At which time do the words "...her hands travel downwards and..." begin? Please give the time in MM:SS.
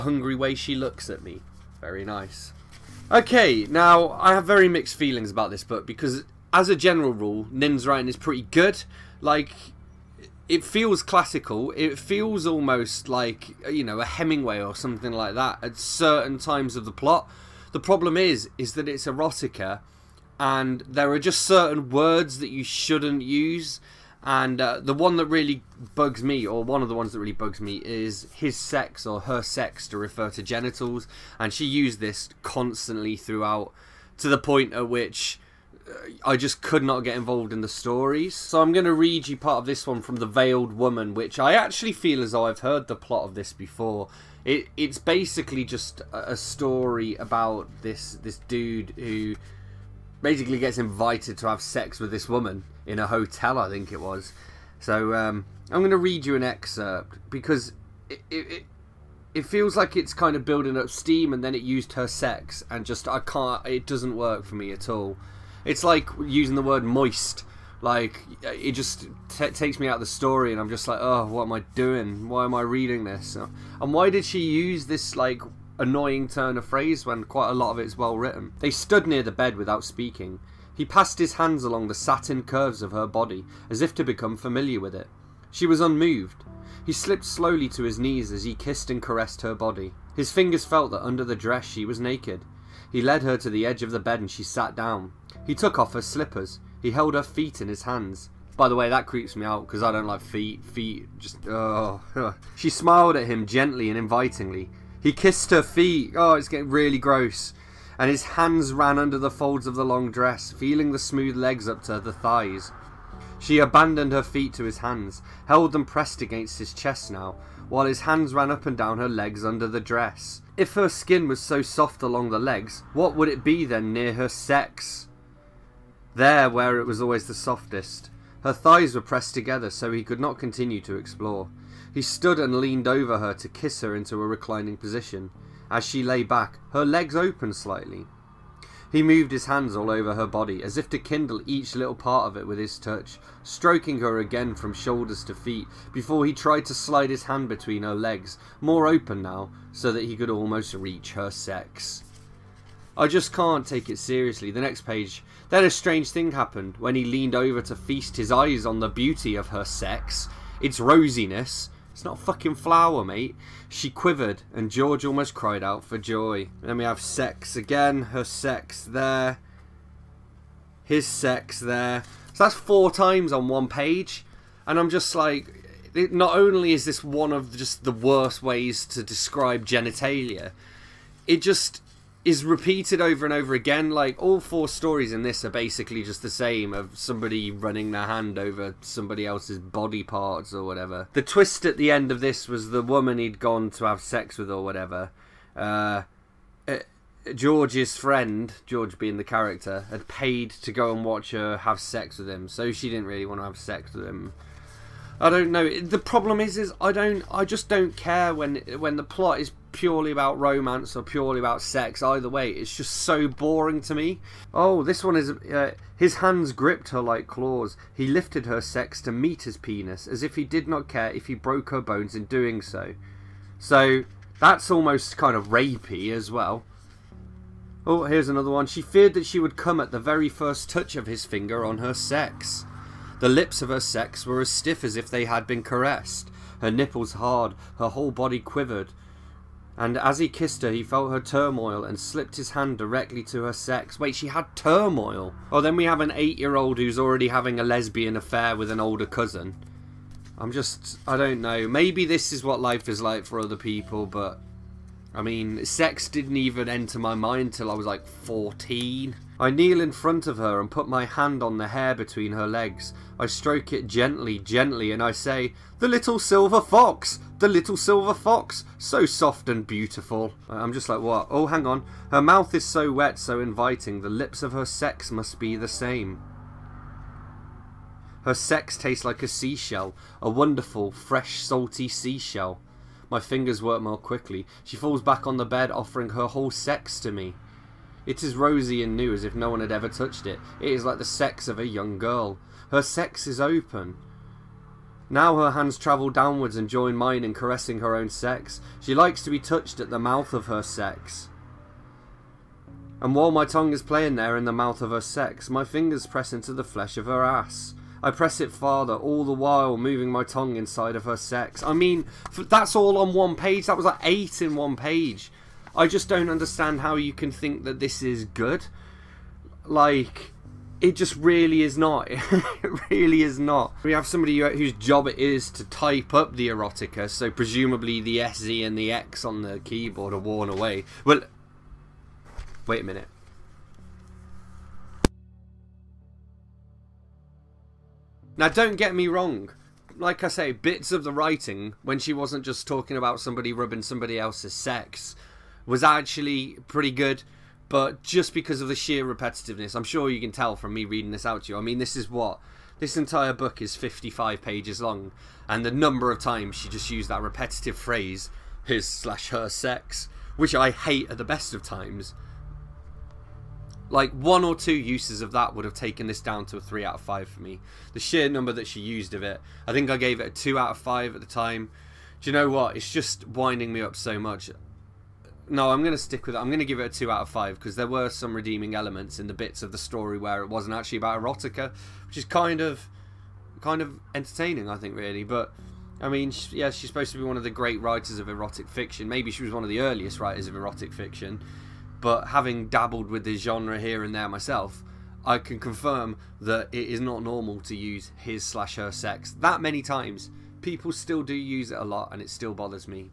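04:55.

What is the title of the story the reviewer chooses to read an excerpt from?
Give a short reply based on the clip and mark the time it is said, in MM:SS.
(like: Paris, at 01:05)
The Veiled Woman, at 00:40.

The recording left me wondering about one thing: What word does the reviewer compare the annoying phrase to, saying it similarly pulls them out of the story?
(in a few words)
moist.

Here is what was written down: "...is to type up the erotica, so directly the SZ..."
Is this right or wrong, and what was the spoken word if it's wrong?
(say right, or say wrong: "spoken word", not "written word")
wrong: "presumably", not "directly".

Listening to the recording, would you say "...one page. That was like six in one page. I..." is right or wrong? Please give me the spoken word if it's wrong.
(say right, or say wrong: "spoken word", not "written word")
wrong: "eight", not "six".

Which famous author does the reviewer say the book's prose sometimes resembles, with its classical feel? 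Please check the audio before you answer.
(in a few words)
Hemingway.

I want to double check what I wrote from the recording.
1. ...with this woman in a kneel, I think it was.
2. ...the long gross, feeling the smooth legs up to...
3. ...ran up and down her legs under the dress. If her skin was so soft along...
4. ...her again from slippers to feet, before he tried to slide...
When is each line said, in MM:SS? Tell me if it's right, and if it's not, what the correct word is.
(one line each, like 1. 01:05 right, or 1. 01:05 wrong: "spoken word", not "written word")
1. 00:51 wrong: "hotel", not "kneel"
2. 01:49 wrong: "dress", not "gross"
3. 01:58 right
4. 02:23 wrong: "shoulders", not "slippers".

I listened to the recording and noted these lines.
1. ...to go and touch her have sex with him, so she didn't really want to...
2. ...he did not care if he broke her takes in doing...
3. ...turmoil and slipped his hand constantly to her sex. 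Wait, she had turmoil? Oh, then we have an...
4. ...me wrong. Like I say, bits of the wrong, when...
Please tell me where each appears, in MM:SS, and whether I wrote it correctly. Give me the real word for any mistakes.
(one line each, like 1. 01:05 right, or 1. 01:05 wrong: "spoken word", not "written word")
1. 03:20 wrong: "watch", not "touch"
2. 03:40 wrong: "bones", not "takes"
3. 04:01 wrong: "directly", not "constantly"
4. 05:38 wrong: "writing", not "wrong".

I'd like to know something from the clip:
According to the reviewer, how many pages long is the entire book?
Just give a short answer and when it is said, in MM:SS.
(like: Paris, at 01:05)
55, at 05:53.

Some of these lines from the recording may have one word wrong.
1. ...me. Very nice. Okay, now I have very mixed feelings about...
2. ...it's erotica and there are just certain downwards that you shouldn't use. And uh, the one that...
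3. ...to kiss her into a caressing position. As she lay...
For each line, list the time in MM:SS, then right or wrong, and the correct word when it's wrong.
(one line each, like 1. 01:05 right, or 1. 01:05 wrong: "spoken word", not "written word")
1. 00:01 right
2. 00:18 wrong: "words", not "downwards"
3. 02:13 wrong: "reclining", not "caressing".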